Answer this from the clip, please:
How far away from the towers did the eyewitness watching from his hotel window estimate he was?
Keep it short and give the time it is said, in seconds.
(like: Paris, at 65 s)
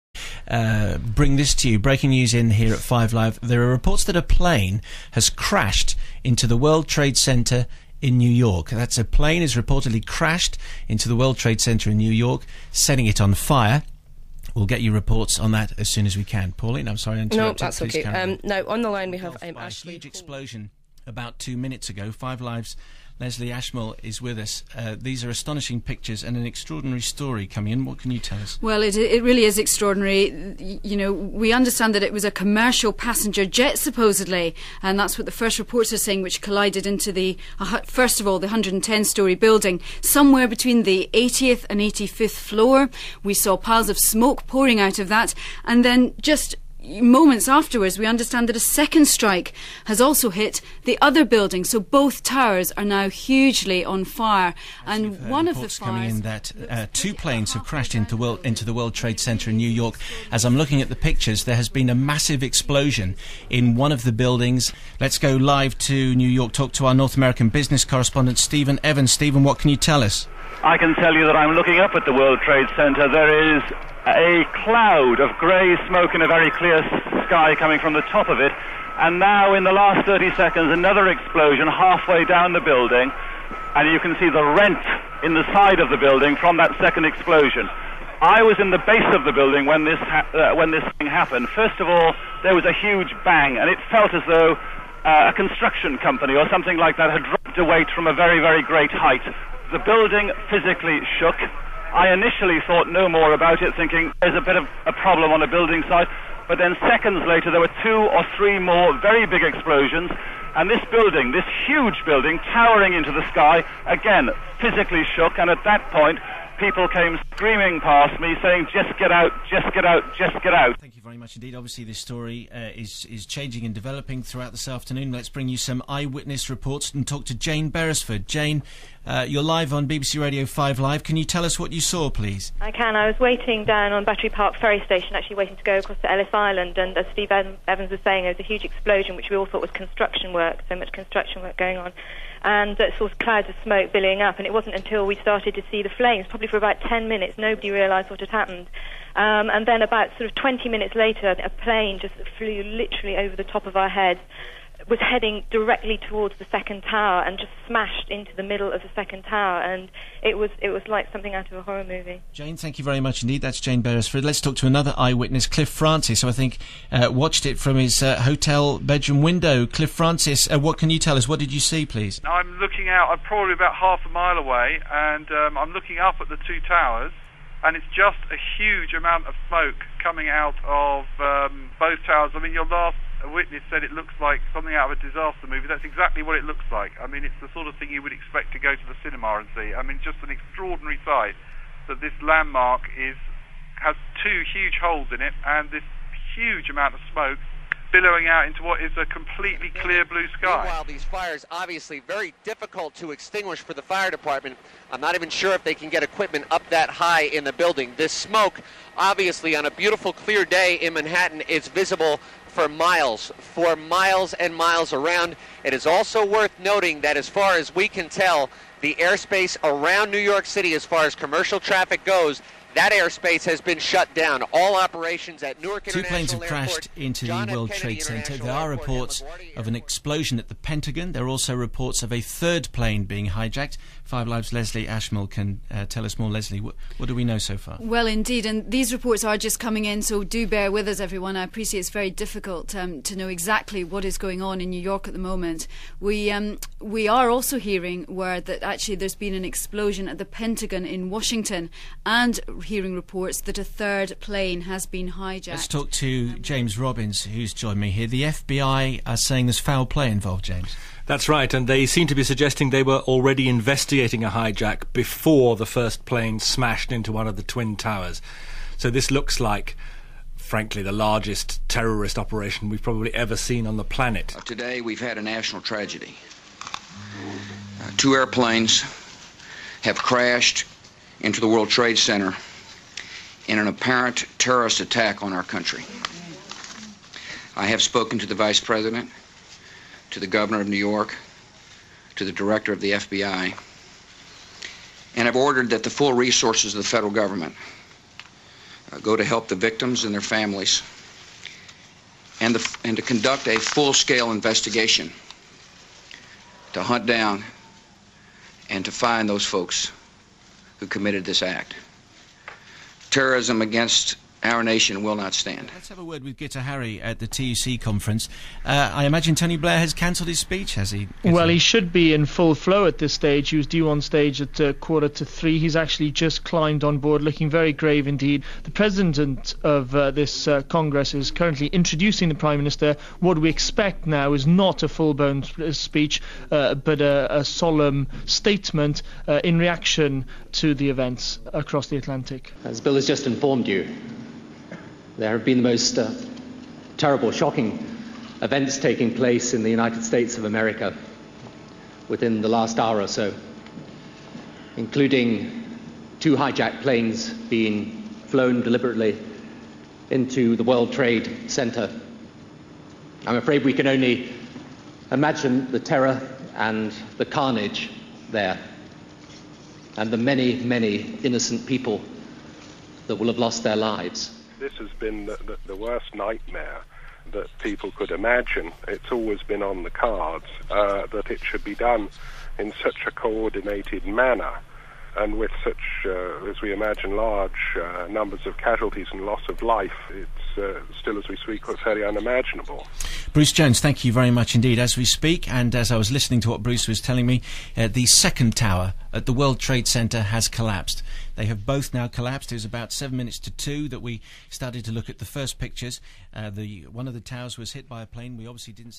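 half a mile, at 173 s.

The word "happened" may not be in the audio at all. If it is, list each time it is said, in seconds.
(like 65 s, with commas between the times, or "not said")
91 s, 148 s.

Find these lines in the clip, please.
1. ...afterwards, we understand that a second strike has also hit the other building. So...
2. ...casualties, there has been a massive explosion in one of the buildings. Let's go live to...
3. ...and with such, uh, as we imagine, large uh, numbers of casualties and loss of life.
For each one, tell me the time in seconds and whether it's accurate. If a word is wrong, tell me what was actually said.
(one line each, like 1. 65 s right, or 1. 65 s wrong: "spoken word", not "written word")
1. 47 s right
2. 60 s wrong: "pictures", not "casualties"
3. 385 s right.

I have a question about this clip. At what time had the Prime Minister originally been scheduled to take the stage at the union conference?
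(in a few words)
quarter to three.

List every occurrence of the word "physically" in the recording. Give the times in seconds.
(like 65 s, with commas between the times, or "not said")
100 s, 114 s.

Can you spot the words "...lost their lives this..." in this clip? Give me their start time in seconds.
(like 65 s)
373 s.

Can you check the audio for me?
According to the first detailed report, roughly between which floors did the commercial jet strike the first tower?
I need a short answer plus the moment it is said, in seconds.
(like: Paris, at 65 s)
80th and 85th floor, at 41 s.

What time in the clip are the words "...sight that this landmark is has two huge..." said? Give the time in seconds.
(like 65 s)
191 s.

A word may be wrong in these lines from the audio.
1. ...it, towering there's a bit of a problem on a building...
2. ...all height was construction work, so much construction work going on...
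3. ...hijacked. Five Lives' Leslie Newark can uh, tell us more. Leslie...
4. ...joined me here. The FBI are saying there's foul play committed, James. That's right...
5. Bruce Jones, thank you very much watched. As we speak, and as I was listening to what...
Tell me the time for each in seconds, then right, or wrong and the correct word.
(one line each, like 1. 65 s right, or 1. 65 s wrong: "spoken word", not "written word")
1. 103 s wrong: "thinking", not "towering"
2. 139 s wrong: "thought", not "height"
3. 233 s wrong: "Ashmole", not "Newark"
4. 257 s wrong: "involved", not "committed"
5. 393 s wrong: "indeed", not "watched".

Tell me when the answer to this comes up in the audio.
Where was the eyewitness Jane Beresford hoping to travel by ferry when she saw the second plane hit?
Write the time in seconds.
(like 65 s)
136 s.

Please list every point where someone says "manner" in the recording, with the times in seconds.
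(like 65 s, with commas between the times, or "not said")
384 s.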